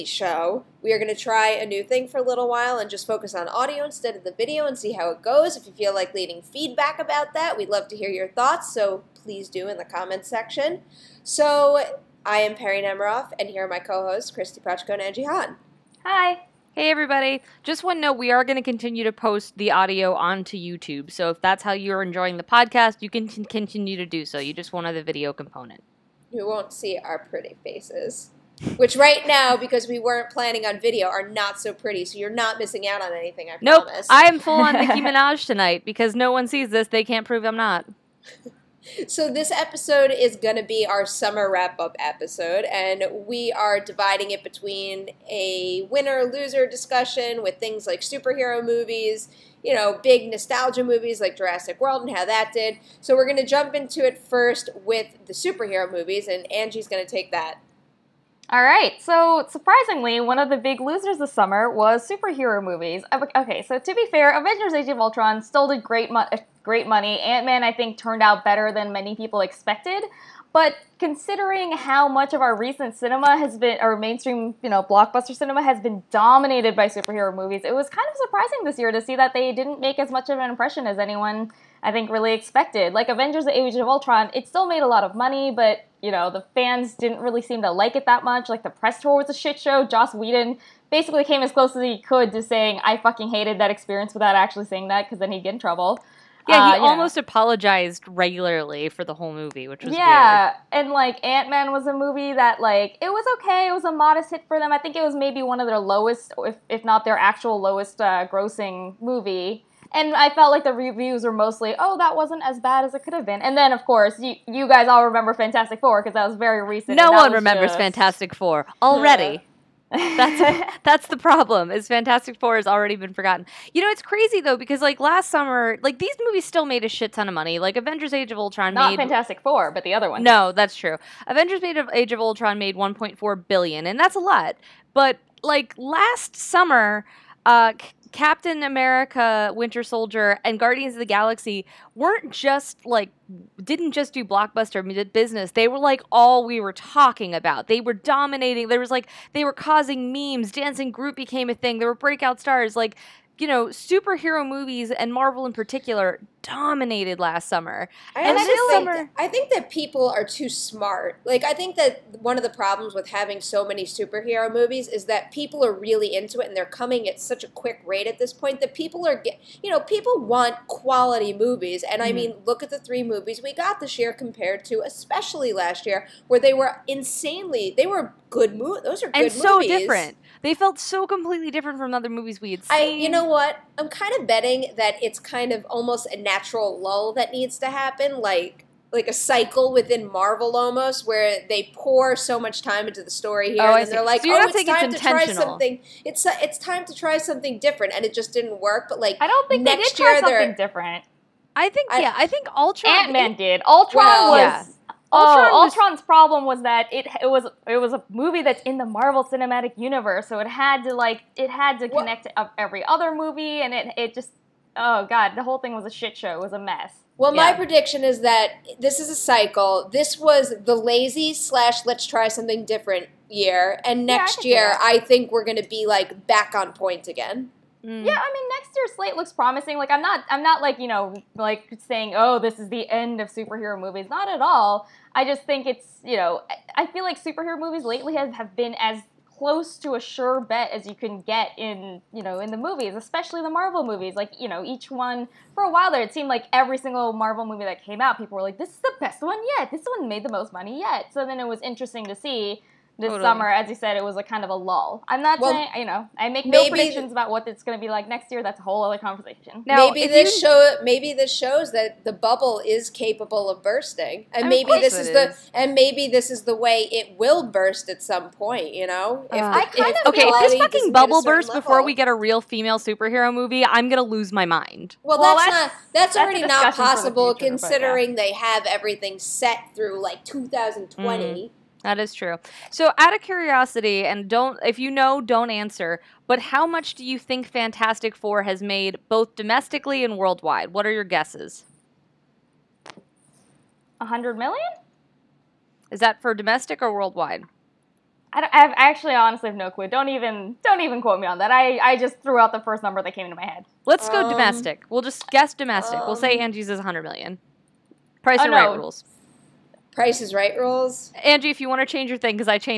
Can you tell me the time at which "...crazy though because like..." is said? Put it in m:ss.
2:04.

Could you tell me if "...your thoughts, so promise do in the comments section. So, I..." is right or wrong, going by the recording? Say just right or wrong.
wrong.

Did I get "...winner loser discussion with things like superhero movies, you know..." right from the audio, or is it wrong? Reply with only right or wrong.
right.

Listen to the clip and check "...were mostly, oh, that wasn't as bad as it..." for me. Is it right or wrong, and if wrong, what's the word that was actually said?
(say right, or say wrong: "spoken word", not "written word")
right.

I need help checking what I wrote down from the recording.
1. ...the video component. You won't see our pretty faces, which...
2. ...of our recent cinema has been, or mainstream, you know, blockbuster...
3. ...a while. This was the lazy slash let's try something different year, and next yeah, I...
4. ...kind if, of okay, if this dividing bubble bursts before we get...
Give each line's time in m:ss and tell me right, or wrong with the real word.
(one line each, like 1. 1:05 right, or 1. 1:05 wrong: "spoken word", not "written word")
1. 0:24 right
2. 1:12 right
3. 3:39 wrong: "cycle", not "while"
4. 4:29 wrong: "fucking", not "dividing".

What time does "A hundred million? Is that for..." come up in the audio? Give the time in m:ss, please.
4:53.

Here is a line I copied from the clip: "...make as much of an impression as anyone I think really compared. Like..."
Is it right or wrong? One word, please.
wrong.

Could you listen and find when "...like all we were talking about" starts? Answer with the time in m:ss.
2:25.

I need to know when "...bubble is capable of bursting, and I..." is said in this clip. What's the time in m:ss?
4:22.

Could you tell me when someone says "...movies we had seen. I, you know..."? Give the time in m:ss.
3:02.